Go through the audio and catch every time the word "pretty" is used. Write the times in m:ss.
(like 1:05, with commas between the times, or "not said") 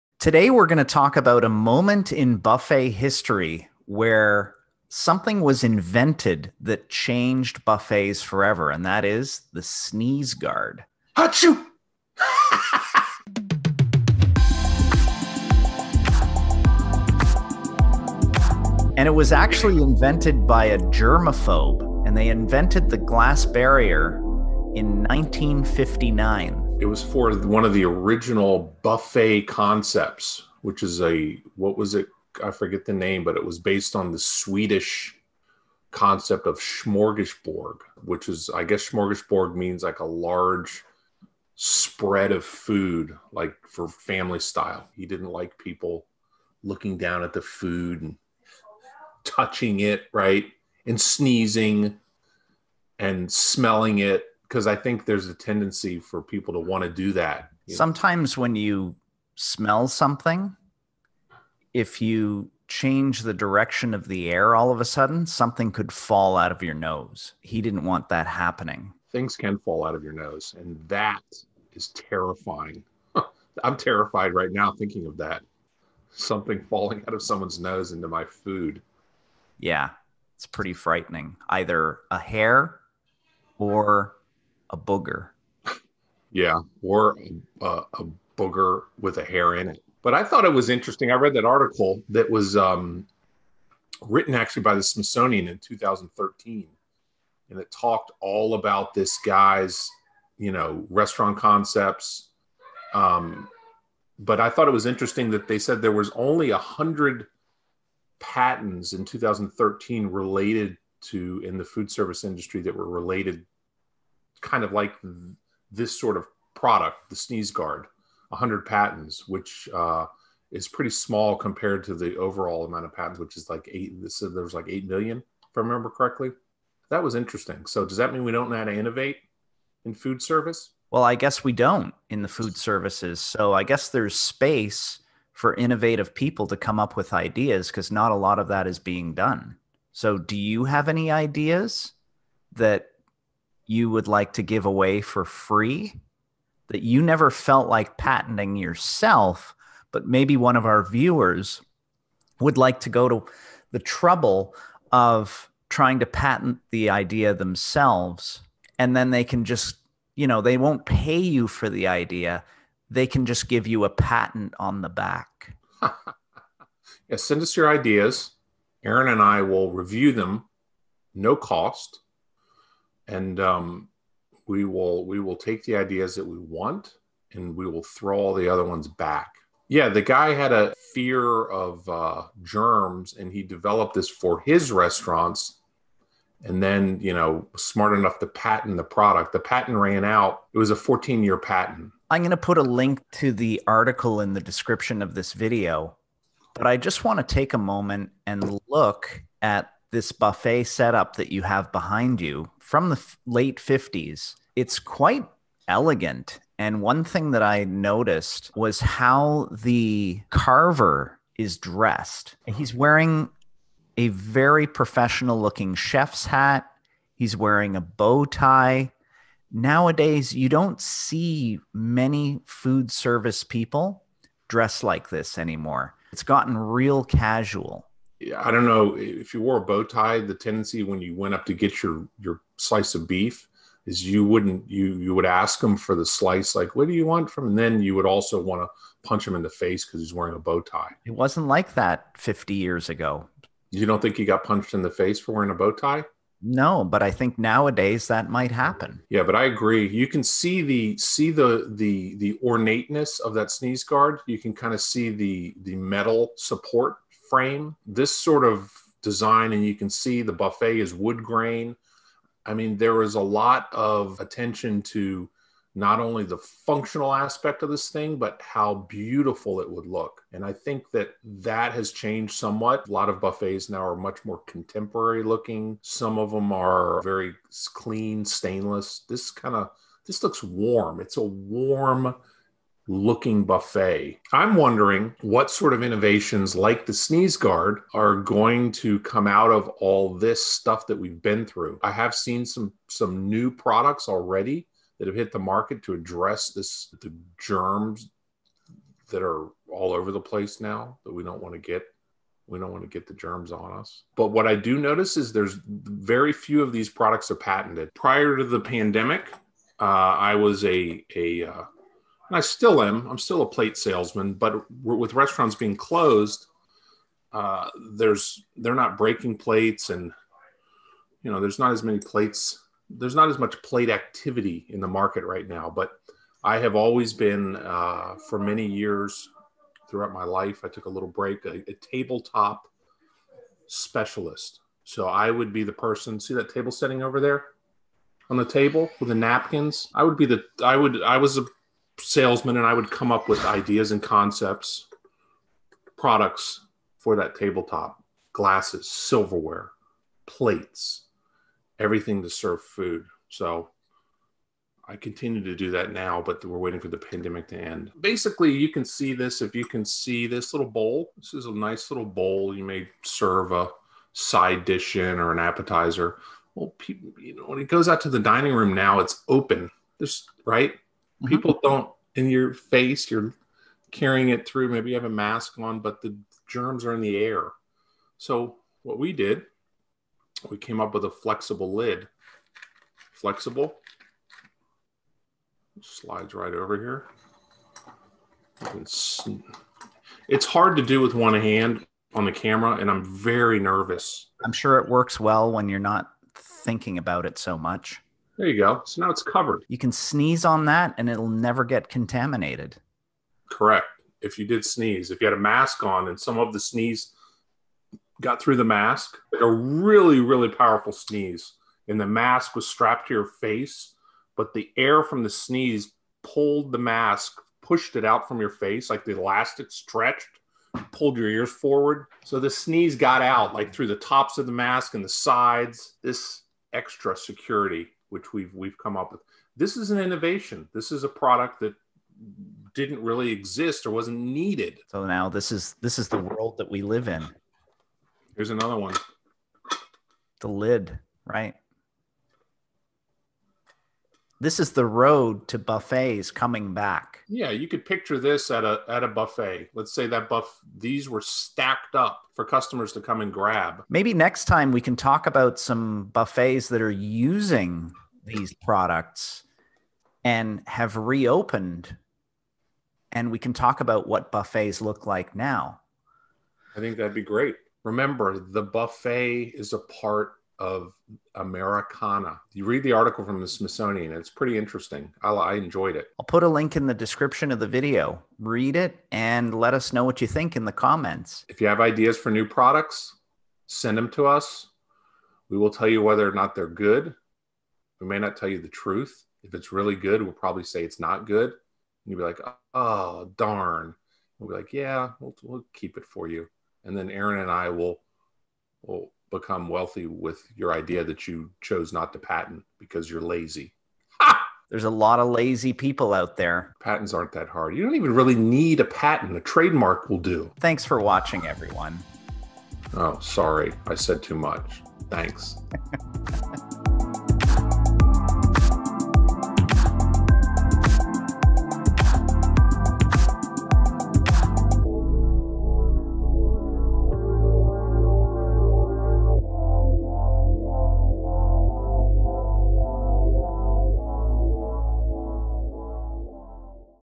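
1:20, 2:00, 7:54.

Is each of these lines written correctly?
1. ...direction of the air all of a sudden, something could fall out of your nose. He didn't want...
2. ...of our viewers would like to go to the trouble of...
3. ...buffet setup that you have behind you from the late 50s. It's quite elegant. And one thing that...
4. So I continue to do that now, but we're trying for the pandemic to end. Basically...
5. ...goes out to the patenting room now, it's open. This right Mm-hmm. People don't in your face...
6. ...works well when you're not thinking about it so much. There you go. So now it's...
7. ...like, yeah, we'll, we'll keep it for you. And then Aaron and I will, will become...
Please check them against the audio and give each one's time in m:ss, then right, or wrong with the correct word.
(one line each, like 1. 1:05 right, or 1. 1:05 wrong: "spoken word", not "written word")
1. 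1:03 right
2. 2:30 right
3. 3:20 right
4. 5:53 wrong: "waiting", not "trying"
5. 6:07 wrong: "dining", not "patenting"
6. 6:34 right
7. 8:14 right.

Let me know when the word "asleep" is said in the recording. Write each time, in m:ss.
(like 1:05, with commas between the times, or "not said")
not said.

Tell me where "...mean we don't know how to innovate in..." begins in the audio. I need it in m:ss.
2:08.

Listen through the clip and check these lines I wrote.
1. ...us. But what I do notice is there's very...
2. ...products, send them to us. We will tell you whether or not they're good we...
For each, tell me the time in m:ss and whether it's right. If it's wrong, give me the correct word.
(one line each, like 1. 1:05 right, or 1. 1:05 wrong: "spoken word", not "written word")
1. 5:03 right
2. 8:02 right.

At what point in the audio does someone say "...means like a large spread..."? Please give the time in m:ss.
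0:39.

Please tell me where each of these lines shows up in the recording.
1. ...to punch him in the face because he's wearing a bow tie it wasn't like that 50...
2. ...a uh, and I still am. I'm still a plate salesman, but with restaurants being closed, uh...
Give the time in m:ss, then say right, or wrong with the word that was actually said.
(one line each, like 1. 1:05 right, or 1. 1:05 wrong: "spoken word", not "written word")
1. 3:58 right
2. 5:11 right.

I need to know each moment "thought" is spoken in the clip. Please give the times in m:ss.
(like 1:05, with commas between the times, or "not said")
1:30, 1:44.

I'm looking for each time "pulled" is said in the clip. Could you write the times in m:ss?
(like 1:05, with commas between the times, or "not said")
6:56, 7:00.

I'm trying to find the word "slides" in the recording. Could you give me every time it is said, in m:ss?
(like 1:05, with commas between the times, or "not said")
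6:25.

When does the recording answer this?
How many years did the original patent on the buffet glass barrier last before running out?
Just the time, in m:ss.
3:10.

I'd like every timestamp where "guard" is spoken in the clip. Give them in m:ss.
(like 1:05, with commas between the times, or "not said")
0:10, 1:57, 4:13, 4:47.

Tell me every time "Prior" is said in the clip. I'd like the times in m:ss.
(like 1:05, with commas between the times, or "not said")
5:07.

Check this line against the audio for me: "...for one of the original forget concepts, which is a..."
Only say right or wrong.
wrong.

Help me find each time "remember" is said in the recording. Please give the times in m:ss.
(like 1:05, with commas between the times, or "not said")
2:05, 7:47.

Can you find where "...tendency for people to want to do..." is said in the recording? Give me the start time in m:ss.
0:55.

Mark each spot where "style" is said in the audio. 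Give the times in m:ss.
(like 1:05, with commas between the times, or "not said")
0:44.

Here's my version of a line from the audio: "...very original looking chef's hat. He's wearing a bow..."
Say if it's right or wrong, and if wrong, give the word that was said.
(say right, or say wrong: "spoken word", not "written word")
wrong: "professional", not "original".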